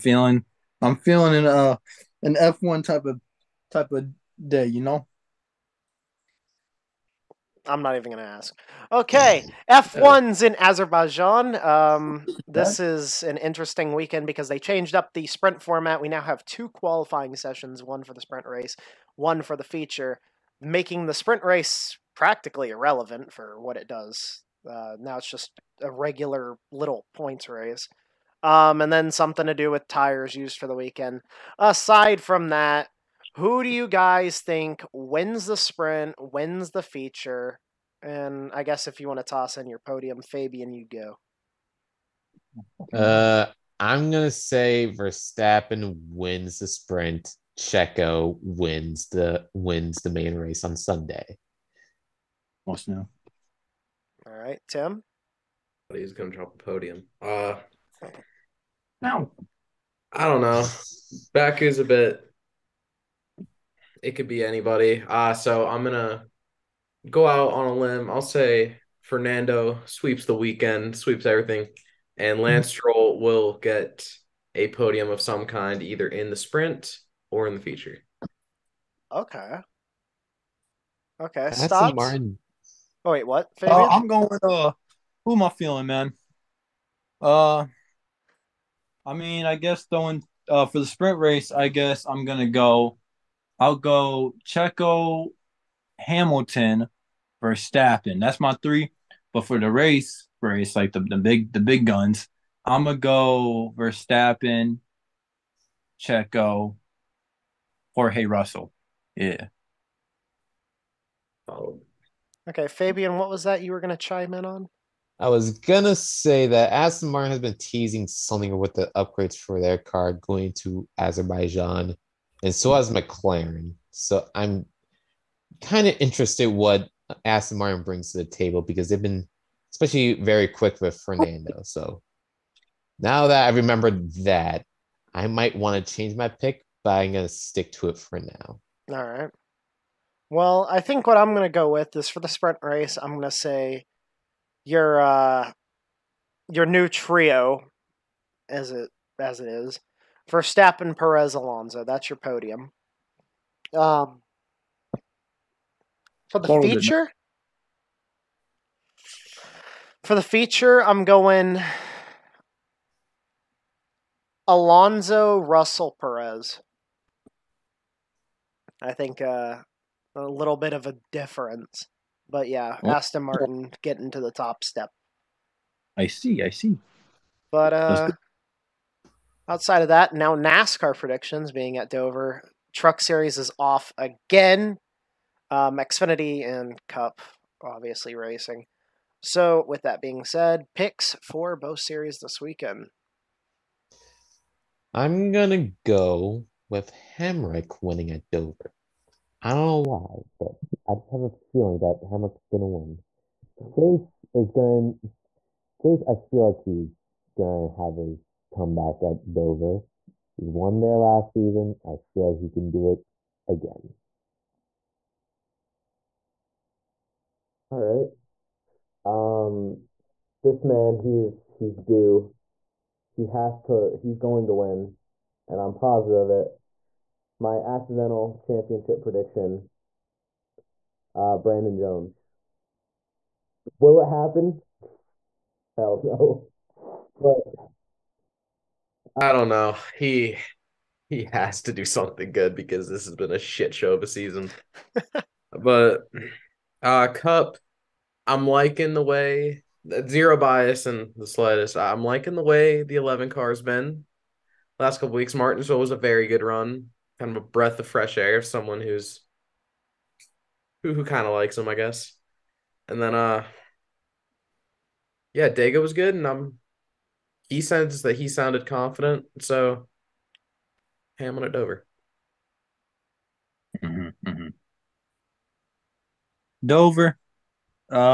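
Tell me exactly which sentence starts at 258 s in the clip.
Someone who's who who kind of likes him, I guess.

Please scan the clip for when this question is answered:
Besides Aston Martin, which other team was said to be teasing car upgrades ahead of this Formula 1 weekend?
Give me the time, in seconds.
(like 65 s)
122 s.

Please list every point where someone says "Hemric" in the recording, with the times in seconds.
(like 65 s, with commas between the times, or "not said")
197 s, 202 s.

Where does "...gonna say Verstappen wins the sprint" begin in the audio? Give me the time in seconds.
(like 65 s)
44 s.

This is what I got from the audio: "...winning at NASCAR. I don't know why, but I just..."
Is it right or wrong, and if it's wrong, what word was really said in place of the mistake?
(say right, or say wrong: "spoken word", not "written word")
wrong: "Dover", not "NASCAR".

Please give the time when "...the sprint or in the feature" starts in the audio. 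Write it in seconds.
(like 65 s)
76 s.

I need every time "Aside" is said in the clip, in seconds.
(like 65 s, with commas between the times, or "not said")
31 s.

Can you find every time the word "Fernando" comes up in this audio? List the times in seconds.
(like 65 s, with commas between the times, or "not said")
69 s, 130 s.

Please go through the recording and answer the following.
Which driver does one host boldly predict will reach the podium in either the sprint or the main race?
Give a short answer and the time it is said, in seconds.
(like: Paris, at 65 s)
Lance Stroll, at 72 s.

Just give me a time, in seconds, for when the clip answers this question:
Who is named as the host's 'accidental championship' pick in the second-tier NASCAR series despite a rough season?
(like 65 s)
231 s.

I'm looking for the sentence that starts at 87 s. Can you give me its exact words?
Uh, I mean, I guess throwing uh for the sprint race, I guess I'm gonna go I'll go Checo, Hamilton, Verstappen.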